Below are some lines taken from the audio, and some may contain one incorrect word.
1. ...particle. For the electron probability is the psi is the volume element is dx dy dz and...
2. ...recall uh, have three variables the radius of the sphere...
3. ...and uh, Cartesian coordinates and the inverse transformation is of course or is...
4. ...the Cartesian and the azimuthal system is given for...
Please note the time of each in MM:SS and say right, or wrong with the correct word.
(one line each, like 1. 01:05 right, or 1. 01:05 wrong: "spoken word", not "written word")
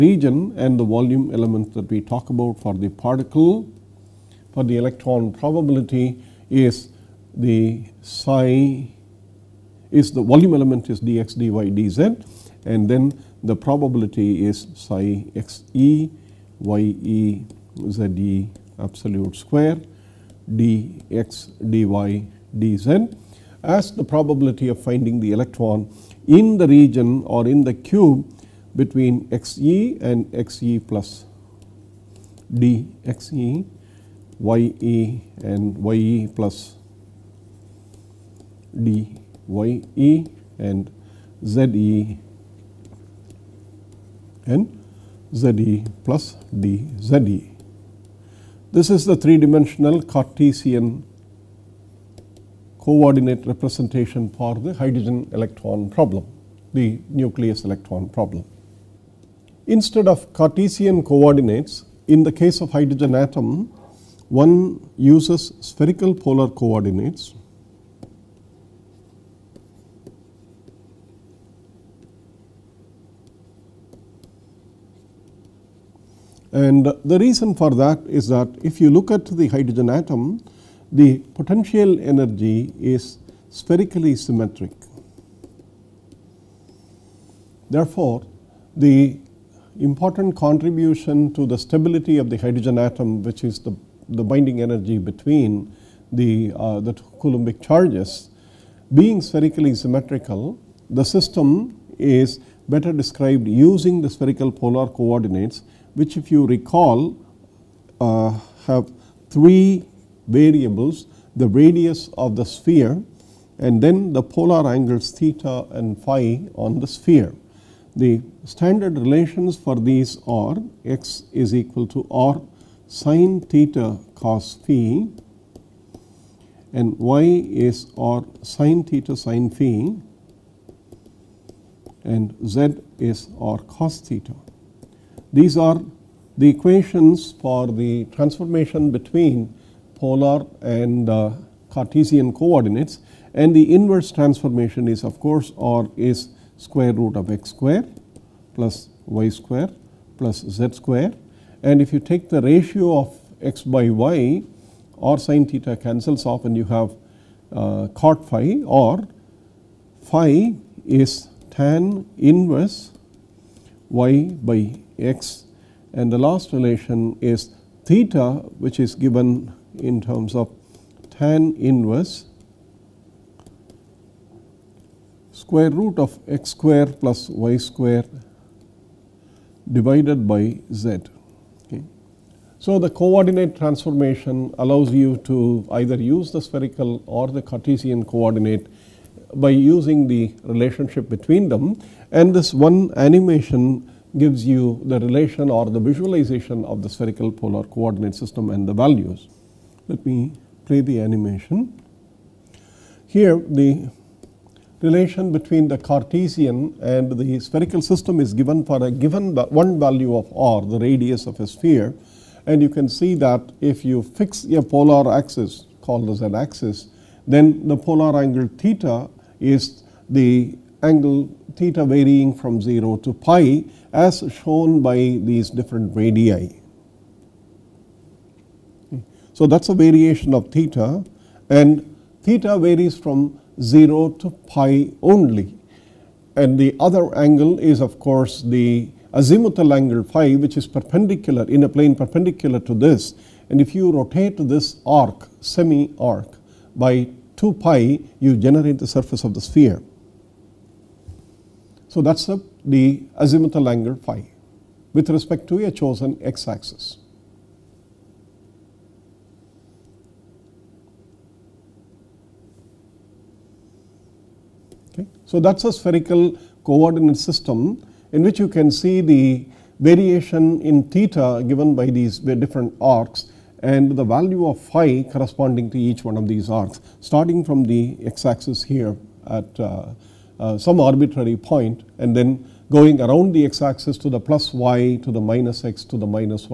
1. 00:02 right
2. 01:46 right
3. 02:20 right
4. 03:25 wrong: "spherical", not "azimuthal".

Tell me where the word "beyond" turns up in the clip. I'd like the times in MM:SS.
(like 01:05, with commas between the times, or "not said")
not said.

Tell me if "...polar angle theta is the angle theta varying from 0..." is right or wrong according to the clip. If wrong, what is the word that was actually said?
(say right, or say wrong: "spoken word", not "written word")
right.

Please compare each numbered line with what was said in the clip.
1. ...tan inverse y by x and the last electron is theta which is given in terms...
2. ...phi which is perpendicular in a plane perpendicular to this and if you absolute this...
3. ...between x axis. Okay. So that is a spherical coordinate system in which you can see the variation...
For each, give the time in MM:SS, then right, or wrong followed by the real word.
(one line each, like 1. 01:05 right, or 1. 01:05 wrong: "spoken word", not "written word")
1. 02:41 wrong: "relation", not "electron"
2. 04:00 wrong: "rotate", not "absolute"
3. 04:15 wrong: "chosen", not "between".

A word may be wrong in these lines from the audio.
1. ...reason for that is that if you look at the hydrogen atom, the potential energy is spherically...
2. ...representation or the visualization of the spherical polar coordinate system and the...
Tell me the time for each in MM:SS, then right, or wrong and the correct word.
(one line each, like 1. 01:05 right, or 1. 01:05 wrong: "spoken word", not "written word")
1. 01:17 right
2. 03:15 wrong: "relation", not "representation".